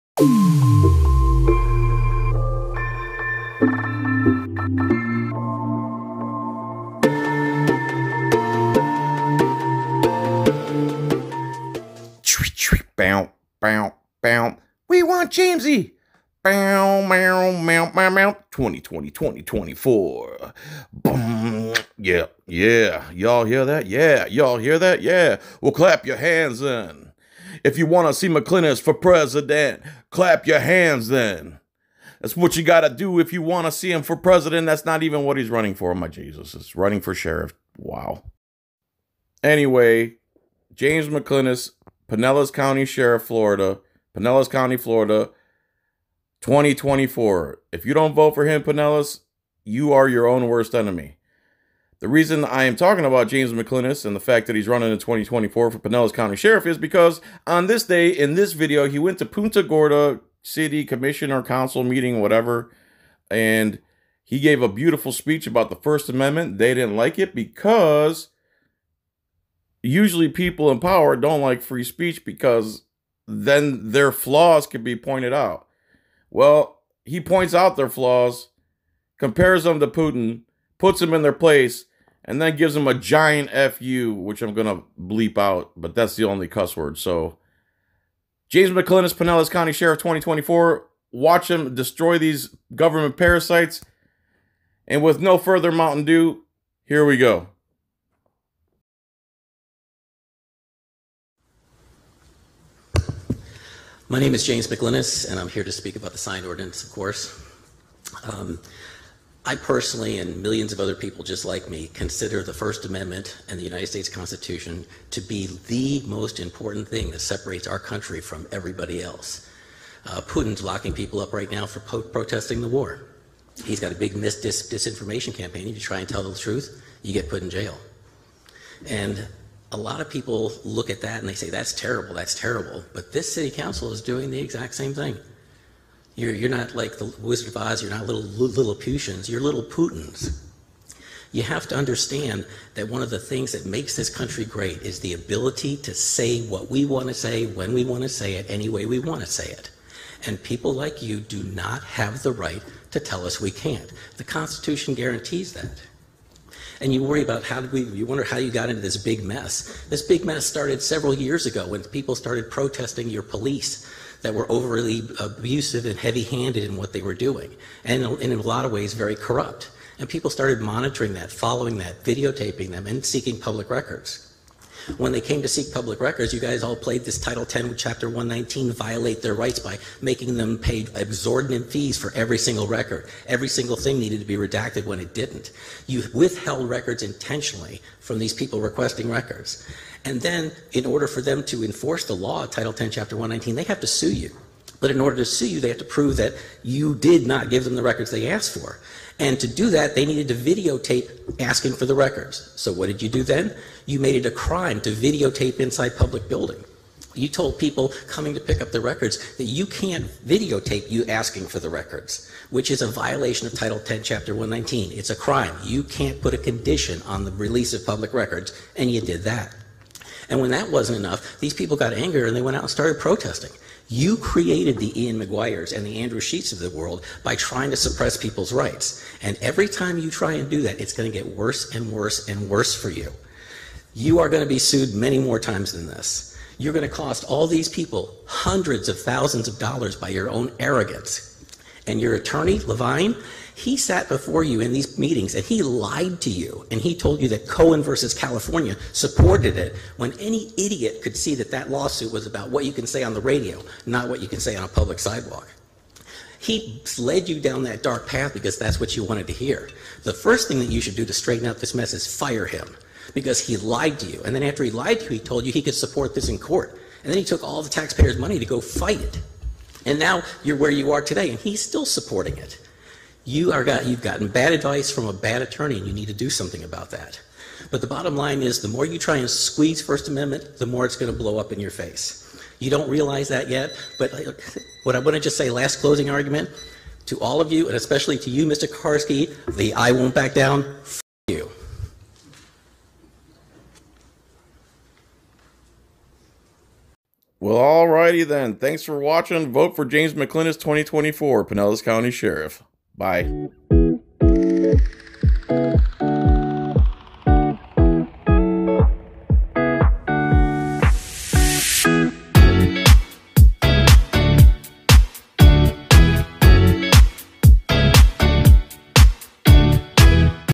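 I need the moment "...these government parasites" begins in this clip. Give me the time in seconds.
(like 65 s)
92 s.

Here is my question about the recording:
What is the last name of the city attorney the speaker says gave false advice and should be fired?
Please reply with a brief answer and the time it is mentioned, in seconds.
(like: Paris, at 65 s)
Levine, at 242 s.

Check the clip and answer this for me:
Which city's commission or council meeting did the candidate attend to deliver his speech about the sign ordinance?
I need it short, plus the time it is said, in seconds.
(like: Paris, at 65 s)
Punta Gorda, at 59 s.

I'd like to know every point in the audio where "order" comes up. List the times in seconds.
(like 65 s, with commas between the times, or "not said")
190 s, 194 s.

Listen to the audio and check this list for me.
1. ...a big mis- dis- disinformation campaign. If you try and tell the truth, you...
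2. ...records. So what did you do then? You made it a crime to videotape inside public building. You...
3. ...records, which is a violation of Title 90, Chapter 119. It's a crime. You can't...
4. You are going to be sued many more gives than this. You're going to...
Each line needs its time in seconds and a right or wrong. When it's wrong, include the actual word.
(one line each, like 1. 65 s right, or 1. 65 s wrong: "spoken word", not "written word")
1. 123 s right
2. 201 s right
3. 211 s wrong: "10", not "90"
4. 233 s wrong: "times", not "gives".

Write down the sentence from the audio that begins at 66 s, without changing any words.
They didn't like it because usually people in power don't like free speech because then their flaws can be pointed out.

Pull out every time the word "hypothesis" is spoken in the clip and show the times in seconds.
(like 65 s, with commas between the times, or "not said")
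not said.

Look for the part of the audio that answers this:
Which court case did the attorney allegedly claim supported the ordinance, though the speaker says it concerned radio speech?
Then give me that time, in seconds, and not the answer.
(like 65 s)
247 s.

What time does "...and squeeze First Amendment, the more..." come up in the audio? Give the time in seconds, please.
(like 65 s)
279 s.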